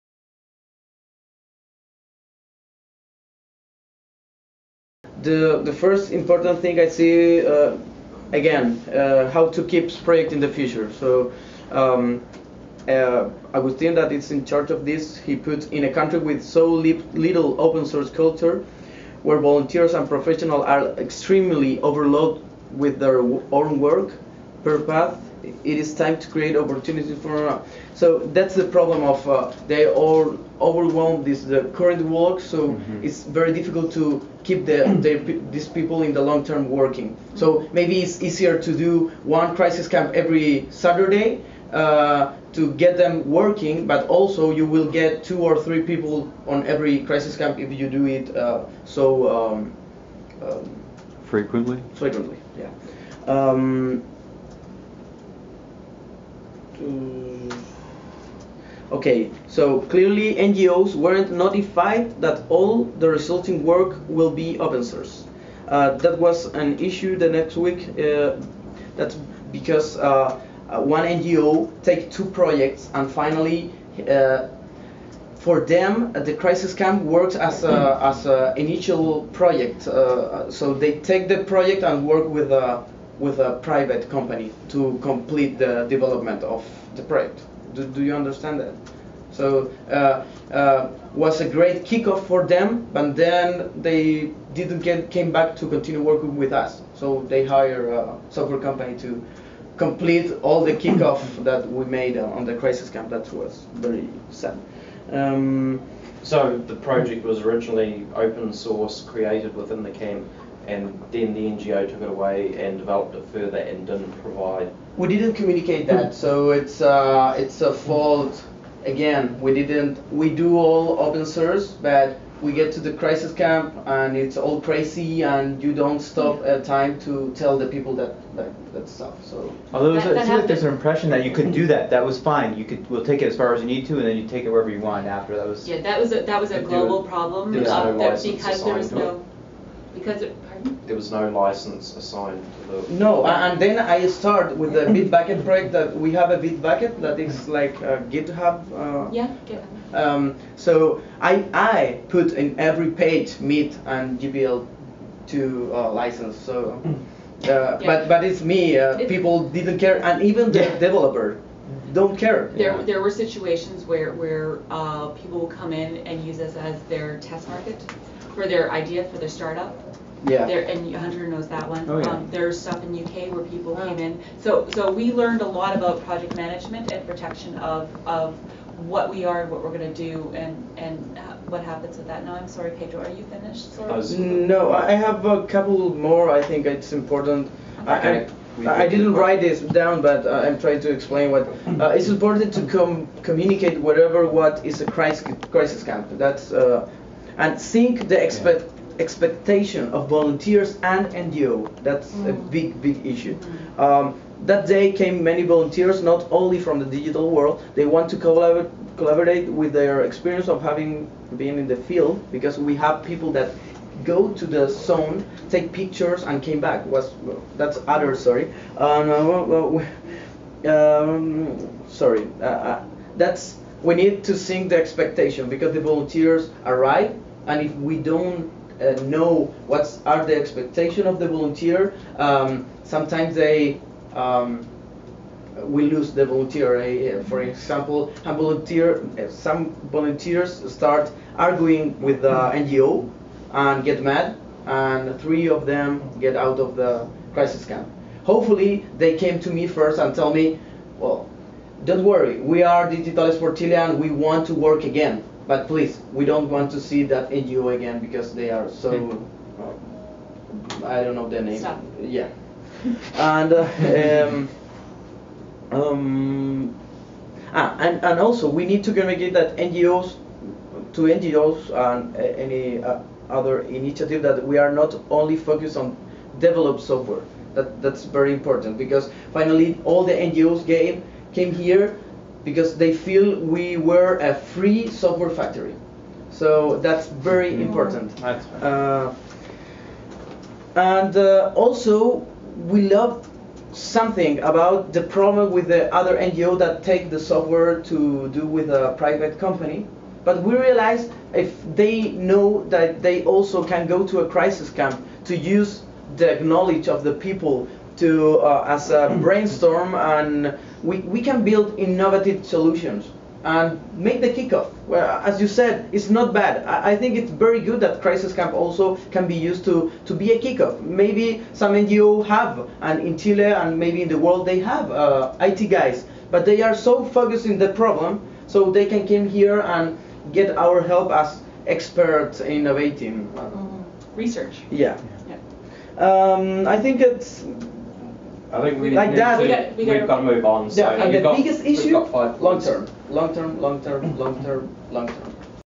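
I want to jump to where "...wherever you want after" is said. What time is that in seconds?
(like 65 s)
134 s.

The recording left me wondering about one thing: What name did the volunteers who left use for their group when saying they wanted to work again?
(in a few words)
Digital por Chile.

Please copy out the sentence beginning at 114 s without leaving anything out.
We didn't communicate that, so it's uh, it's a fault.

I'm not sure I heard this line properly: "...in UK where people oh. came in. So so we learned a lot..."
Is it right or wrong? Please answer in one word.
right.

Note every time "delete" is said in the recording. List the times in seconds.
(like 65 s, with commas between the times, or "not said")
not said.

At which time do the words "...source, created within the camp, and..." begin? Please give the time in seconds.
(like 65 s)
108 s.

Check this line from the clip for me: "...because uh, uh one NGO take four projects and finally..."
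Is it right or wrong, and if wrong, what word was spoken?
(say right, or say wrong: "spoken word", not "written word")
wrong: "two", not "four".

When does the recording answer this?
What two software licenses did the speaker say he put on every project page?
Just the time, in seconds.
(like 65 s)
153 s.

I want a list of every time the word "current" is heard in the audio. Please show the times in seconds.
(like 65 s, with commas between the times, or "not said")
31 s.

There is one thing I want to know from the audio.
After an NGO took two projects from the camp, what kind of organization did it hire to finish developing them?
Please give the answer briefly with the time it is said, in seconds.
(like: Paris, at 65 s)
a software company, at 98 s.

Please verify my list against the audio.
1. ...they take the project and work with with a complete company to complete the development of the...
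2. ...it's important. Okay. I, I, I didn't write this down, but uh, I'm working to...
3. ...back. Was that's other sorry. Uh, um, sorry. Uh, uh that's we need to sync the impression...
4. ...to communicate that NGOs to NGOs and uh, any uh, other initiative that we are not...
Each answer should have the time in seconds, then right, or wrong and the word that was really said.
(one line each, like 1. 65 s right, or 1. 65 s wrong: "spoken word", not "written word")
1. 80 s wrong: "private", not "complete"
2. 186 s wrong: "trying", not "working"
3. 216 s wrong: "expectation", not "impression"
4. 268 s right.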